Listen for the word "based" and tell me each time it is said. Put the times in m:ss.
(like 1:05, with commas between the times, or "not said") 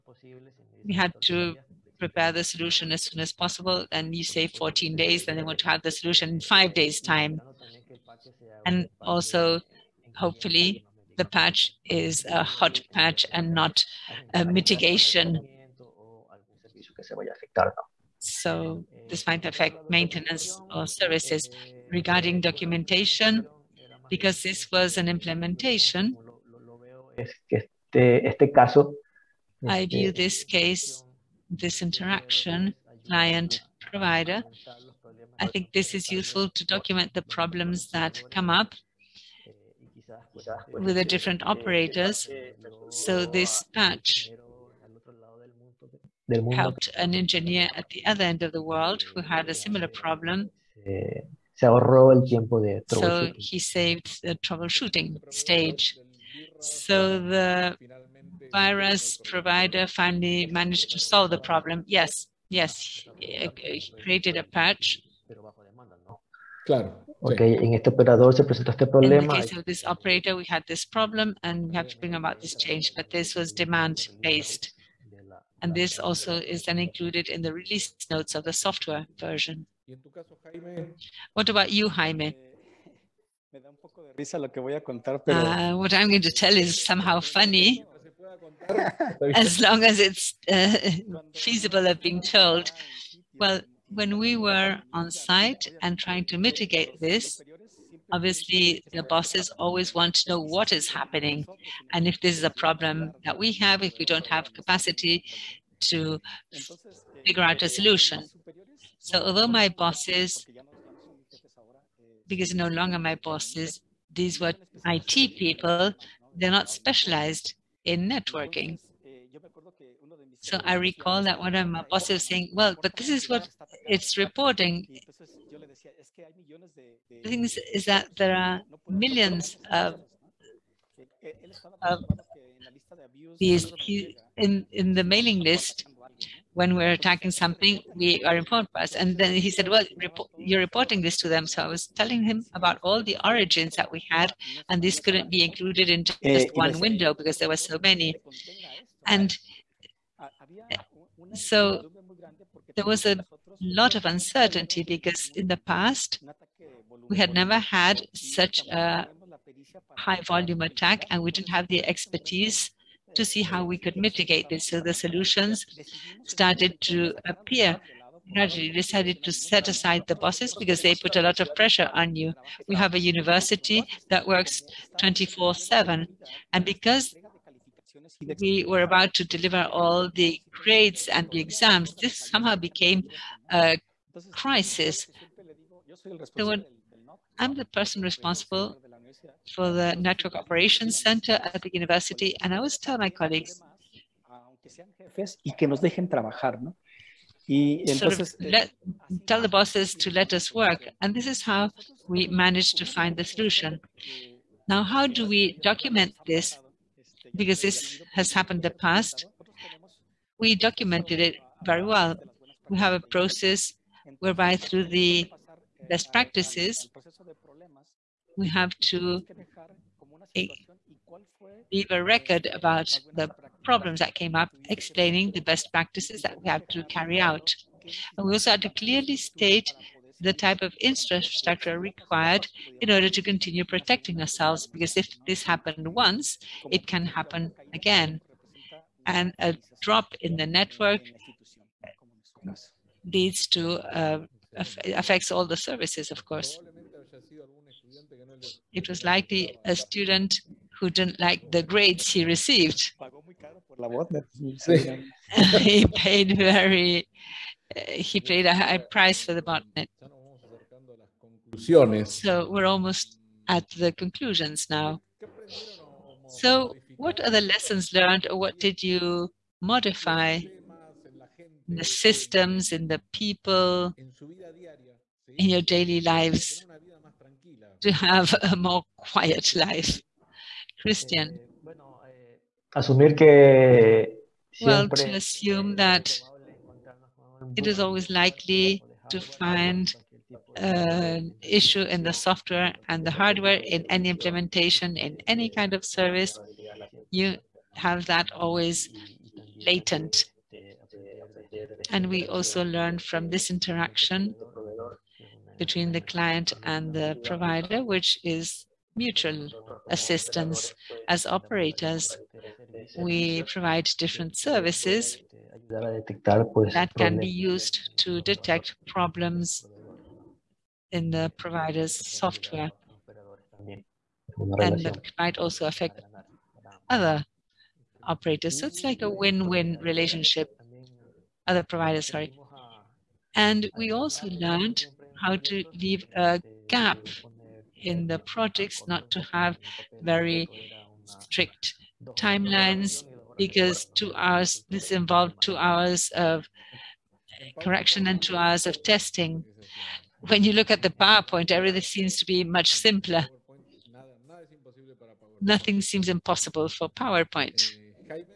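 1:13.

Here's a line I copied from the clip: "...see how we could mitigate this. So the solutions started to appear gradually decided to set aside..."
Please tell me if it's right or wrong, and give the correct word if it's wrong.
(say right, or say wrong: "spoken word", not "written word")
right.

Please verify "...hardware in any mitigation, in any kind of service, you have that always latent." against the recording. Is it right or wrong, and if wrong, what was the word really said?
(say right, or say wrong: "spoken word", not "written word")
wrong: "implementation", not "mitigation".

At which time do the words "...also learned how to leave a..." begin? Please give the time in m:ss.
5:33.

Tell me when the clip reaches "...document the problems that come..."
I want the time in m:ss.
0:36.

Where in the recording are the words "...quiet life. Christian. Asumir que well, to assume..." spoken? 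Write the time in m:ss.
4:38.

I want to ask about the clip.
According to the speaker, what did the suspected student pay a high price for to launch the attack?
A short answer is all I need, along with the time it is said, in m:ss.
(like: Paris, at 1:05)
Botnet, at 4:19.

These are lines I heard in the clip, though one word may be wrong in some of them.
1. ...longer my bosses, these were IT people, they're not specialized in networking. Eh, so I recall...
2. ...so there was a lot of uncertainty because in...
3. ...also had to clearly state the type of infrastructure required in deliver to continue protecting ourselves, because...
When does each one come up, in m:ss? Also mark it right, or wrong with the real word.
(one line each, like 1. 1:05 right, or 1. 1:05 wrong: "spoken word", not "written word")
1. 1:52 right
2. 2:31 right
3. 3:48 wrong: "order", not "deliver".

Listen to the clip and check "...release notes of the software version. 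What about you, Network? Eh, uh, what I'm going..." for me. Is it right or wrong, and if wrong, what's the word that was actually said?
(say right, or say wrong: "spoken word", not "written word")
wrong: "Jaime", not "Network".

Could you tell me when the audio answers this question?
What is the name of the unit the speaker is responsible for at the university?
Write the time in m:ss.
3:09.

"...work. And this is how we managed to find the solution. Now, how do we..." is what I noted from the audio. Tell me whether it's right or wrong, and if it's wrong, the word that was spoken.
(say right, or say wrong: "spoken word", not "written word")
right.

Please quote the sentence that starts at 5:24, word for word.
And that might also affect other operators.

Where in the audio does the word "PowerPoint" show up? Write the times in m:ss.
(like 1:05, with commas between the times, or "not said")
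5:50, 5:56.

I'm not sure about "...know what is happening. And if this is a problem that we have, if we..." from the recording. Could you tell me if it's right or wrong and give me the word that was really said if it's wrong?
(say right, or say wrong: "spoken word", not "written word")
right.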